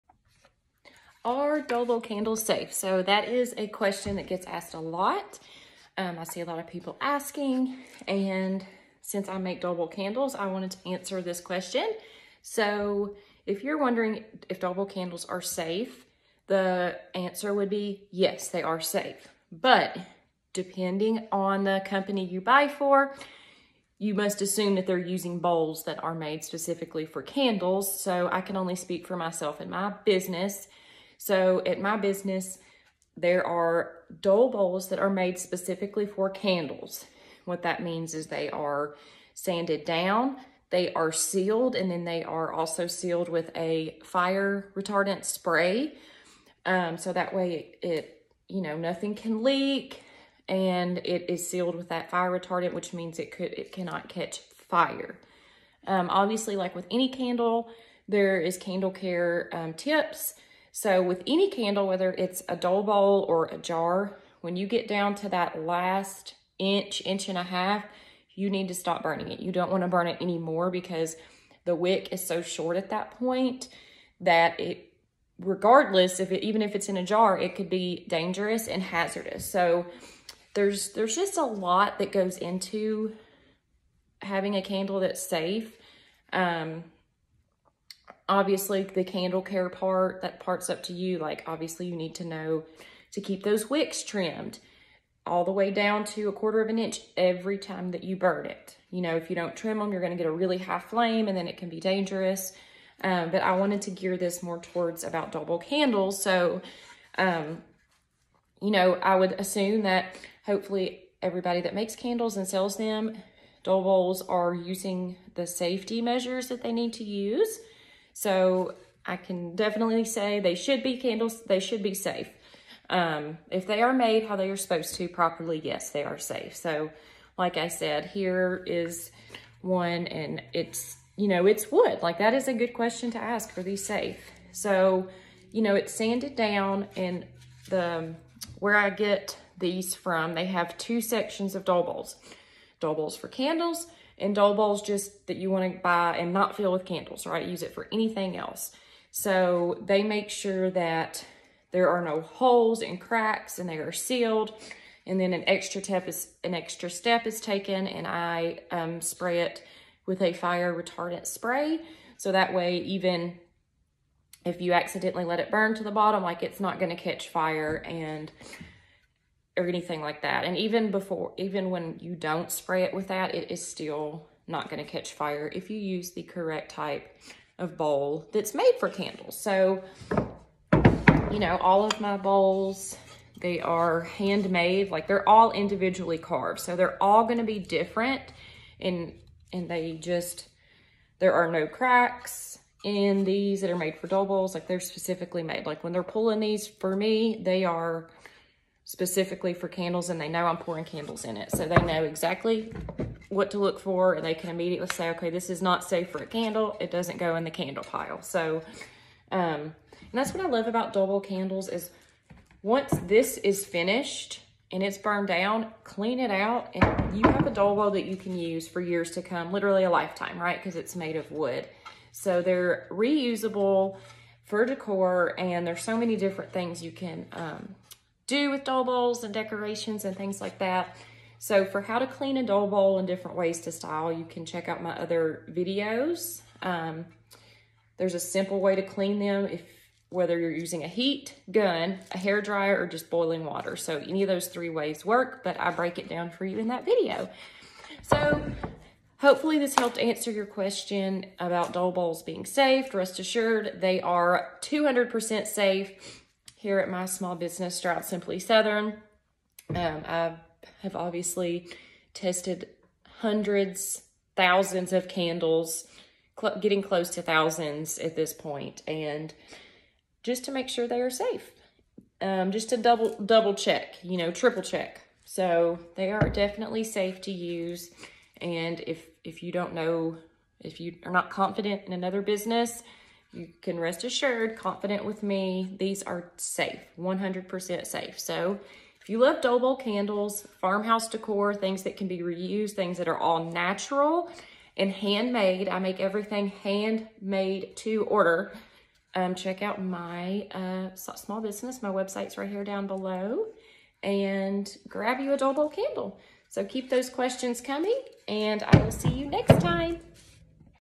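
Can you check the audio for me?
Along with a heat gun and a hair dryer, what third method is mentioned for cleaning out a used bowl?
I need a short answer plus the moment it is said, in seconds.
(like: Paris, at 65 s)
Boiling water, at 243 s.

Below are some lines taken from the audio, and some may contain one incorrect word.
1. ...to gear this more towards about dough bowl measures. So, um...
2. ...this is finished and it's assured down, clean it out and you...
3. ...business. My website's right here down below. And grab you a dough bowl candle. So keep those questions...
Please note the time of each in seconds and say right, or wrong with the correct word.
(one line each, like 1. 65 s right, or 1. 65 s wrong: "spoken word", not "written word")
1. 103 s wrong: "candles", not "measures"
2. 213 s wrong: "burned", not "assured"
3. 301 s right.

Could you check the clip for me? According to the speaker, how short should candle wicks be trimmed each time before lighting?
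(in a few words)
A quarter of an inch.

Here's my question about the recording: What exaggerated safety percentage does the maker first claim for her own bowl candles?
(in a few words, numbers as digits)
200%.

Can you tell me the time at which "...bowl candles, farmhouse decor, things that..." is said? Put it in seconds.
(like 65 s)
289 s.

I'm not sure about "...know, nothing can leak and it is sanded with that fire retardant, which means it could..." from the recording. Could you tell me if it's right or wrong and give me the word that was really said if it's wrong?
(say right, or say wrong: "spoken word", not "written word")
wrong: "sealed", not "sanded".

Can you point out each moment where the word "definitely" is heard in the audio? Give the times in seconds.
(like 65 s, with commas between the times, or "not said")
119 s, 276 s.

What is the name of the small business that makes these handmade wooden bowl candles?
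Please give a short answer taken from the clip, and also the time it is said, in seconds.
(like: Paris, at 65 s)
Stroud Simply Southern, at 257 s.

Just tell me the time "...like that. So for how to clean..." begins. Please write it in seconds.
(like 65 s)
230 s.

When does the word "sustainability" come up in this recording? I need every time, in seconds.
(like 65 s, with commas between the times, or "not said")
not said.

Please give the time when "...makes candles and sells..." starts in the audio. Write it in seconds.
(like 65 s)
111 s.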